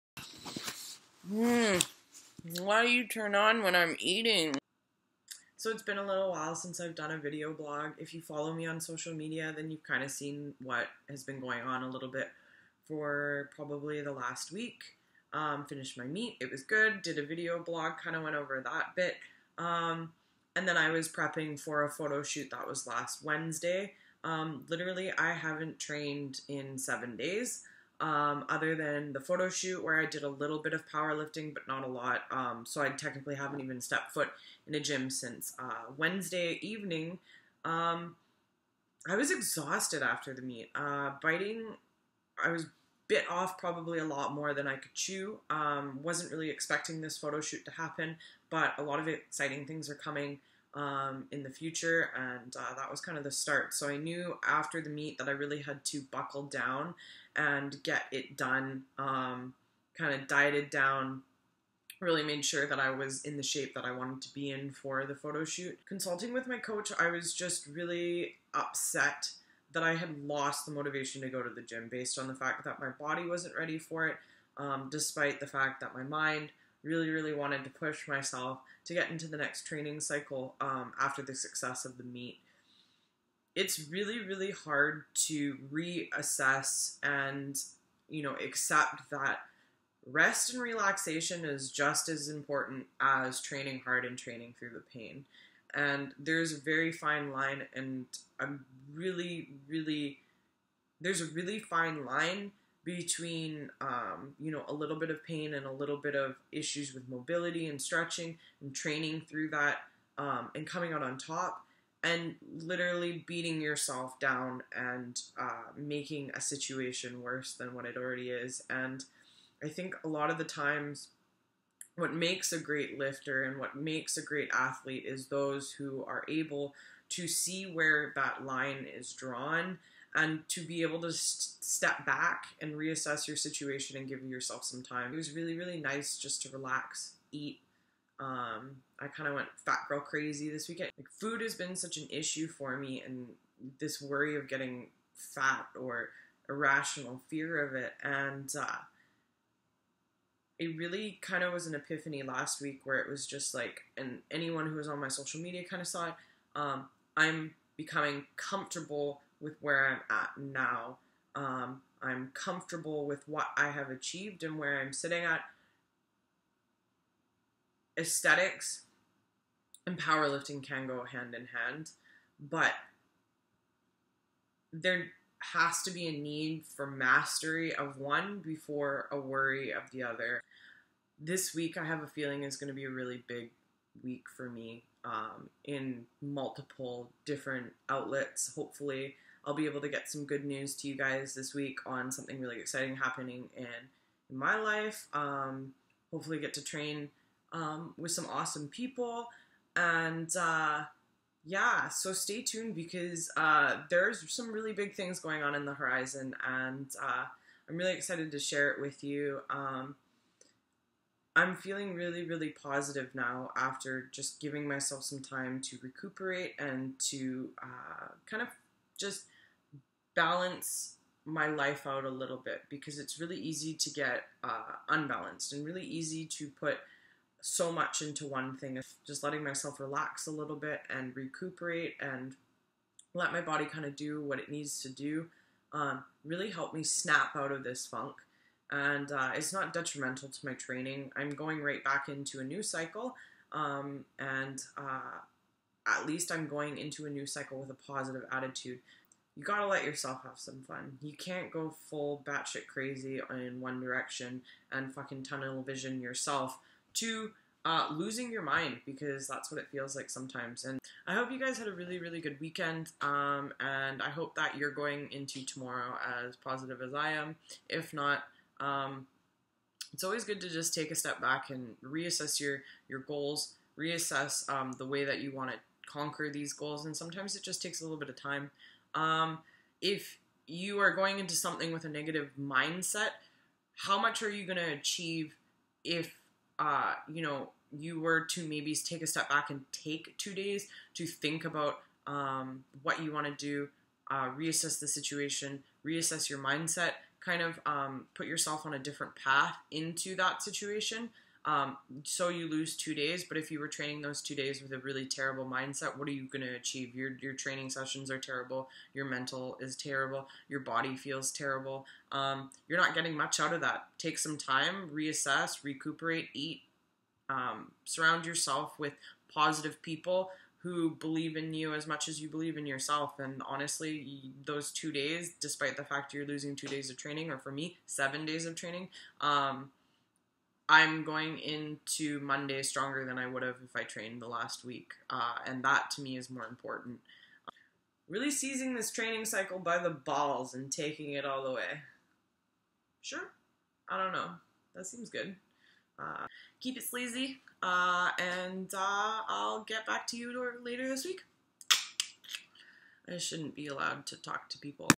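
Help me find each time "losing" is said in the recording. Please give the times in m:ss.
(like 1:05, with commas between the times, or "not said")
4:17, 5:26.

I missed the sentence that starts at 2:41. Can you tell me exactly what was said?
Um, I'm comfortable with what I have achieved and where I'm sitting at.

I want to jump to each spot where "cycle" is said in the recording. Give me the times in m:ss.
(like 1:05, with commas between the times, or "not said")
1:19, 4:02, 4:07, 5:39.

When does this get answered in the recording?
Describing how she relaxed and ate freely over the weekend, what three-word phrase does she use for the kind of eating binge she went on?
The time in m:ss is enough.
2:19.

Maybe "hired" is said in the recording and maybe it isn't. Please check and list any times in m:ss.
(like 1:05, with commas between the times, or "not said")
not said.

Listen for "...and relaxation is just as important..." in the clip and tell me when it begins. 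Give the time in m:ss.
1:30.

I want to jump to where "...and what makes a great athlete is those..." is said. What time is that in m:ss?
2:03.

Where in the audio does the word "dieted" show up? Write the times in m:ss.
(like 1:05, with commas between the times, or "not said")
1:00.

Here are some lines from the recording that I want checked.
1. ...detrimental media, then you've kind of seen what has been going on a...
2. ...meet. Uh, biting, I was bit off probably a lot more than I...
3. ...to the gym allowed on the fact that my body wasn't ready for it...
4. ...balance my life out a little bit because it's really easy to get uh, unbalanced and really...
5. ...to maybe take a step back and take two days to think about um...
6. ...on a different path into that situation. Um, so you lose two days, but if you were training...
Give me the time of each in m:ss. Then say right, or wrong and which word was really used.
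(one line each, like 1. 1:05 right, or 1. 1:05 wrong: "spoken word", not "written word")
1. 0:08 wrong: "social", not "detrimental"
2. 0:40 right
3. 1:11 wrong: "based", not "allowed"
4. 3:40 right
5. 4:48 right
6. 4:58 right.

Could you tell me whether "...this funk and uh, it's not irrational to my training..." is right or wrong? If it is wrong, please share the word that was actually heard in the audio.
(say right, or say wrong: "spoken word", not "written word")
wrong: "detrimental", not "irrational".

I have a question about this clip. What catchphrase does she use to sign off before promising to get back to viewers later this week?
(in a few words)
keep it sleazy.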